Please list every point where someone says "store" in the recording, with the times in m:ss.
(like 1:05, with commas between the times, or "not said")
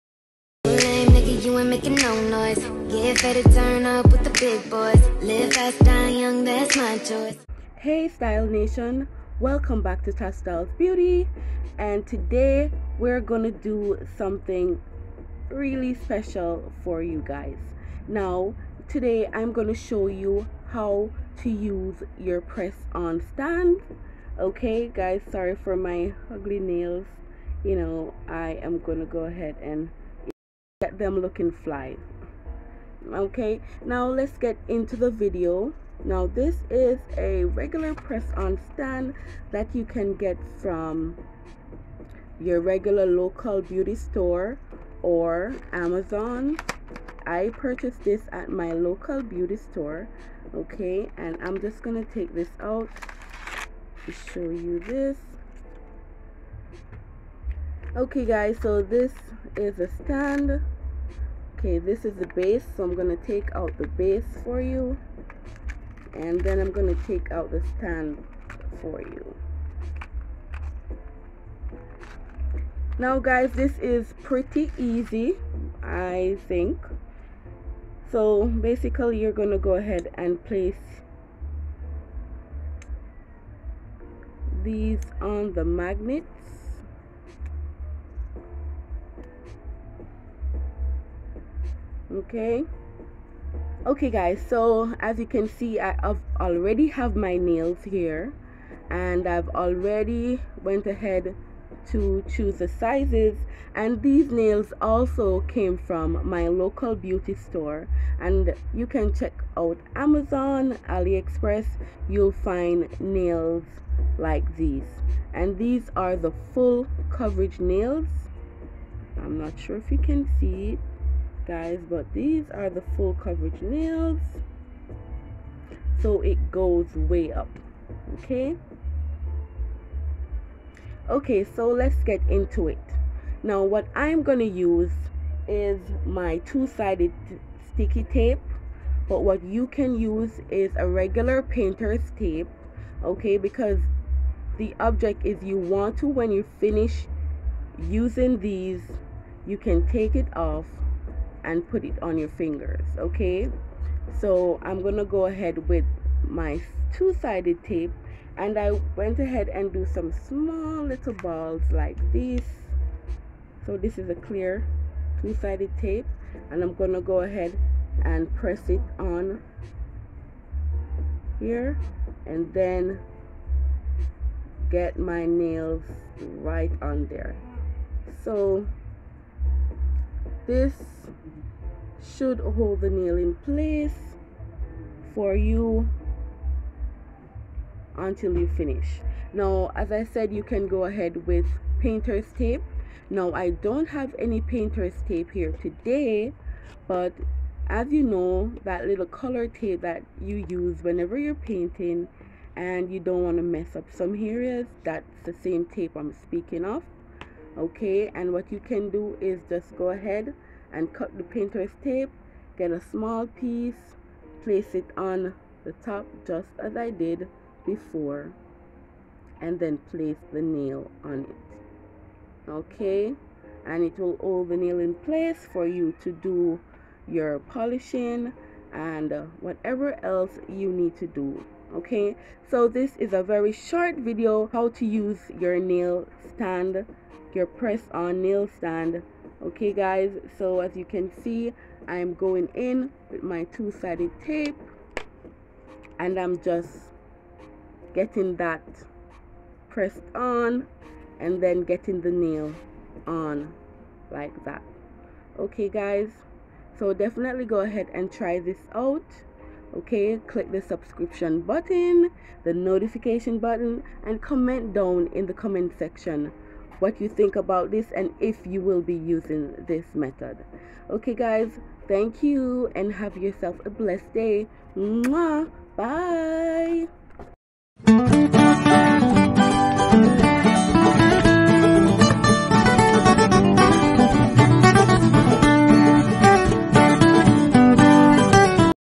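0:43, 0:49, 1:47.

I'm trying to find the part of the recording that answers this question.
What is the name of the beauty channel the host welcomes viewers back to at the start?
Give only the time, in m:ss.
0:10.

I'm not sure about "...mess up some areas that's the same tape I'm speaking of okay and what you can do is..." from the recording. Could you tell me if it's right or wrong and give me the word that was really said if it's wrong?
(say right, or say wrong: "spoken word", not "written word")
right.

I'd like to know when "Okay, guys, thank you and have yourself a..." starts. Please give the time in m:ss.
4:30.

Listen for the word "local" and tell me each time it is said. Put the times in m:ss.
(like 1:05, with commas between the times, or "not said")
0:43, 0:48, 1:46.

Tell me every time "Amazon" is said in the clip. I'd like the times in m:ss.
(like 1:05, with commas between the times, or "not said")
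0:45, 1:49.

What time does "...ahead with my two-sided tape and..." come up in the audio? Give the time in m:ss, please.
2:35.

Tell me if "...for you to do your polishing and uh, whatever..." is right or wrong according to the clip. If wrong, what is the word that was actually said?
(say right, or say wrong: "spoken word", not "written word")
right.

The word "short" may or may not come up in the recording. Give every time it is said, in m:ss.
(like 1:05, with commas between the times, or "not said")
3:53.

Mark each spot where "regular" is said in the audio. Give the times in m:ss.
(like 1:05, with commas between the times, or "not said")
0:37, 0:42, 2:20.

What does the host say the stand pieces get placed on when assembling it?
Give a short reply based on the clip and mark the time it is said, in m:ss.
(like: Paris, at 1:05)
magnets, at 1:25.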